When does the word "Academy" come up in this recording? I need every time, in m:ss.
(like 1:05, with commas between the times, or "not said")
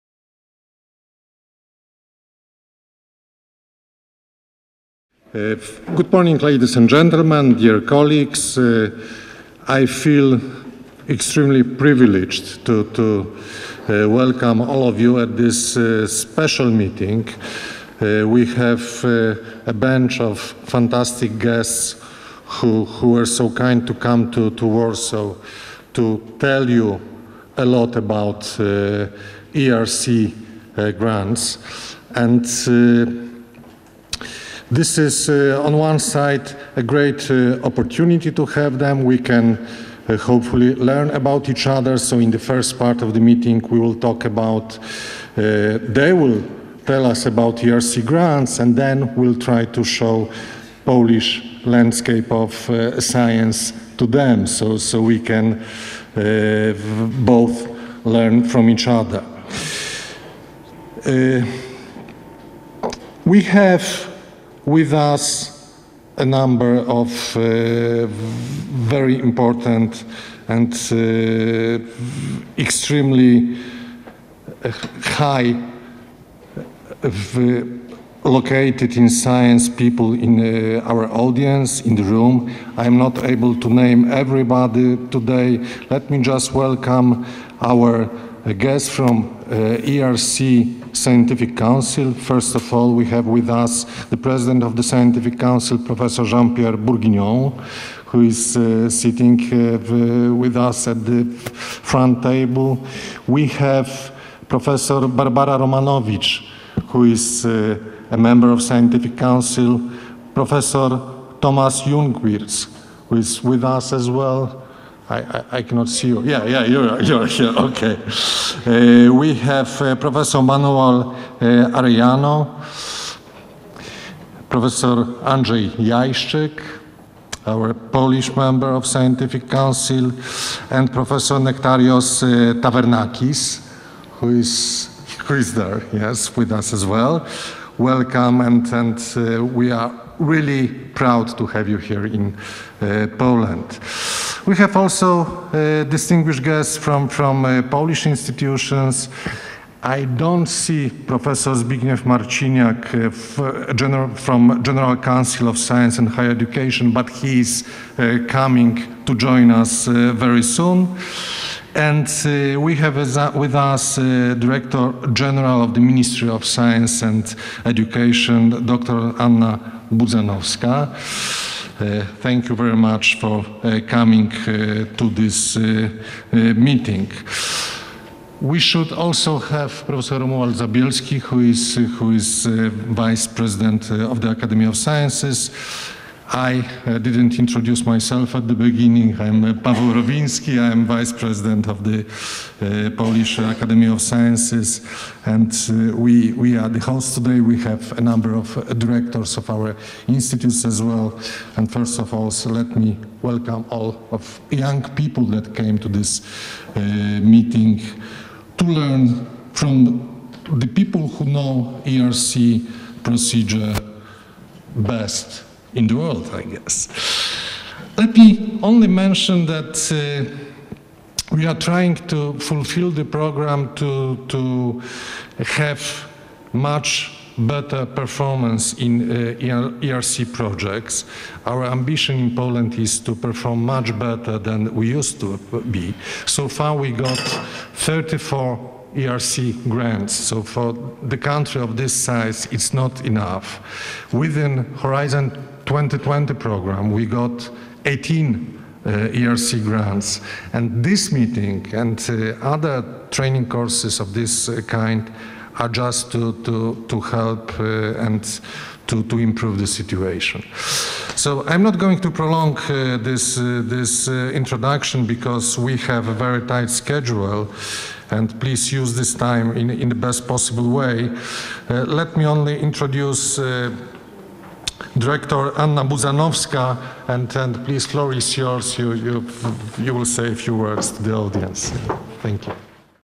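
3:04, 3:13.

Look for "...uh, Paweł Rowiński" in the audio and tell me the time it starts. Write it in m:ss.
3:09.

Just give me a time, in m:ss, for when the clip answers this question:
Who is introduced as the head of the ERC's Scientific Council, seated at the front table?
1:36.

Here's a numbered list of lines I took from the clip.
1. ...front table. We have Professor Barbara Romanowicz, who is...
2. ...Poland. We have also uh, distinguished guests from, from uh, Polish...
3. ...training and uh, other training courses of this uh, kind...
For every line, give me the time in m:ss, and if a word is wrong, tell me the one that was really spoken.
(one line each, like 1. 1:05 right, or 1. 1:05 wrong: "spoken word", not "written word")
1. 1:41 right
2. 2:23 right
3. 4:11 wrong: "meeting", not "training".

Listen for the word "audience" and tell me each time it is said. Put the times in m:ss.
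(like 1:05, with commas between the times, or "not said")
1:21, 4:41.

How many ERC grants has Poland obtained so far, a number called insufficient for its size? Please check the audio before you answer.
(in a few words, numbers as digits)
34.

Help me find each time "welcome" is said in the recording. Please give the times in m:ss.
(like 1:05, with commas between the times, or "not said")
0:14, 1:26, 2:17, 3:23.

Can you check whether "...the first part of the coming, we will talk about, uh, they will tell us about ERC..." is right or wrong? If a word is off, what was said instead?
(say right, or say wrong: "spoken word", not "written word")
wrong: "meeting", not "coming".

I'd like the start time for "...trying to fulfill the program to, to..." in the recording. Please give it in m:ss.
3:41.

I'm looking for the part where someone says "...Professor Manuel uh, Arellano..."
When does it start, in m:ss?
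1:59.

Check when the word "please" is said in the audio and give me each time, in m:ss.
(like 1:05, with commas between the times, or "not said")
4:28, 4:37.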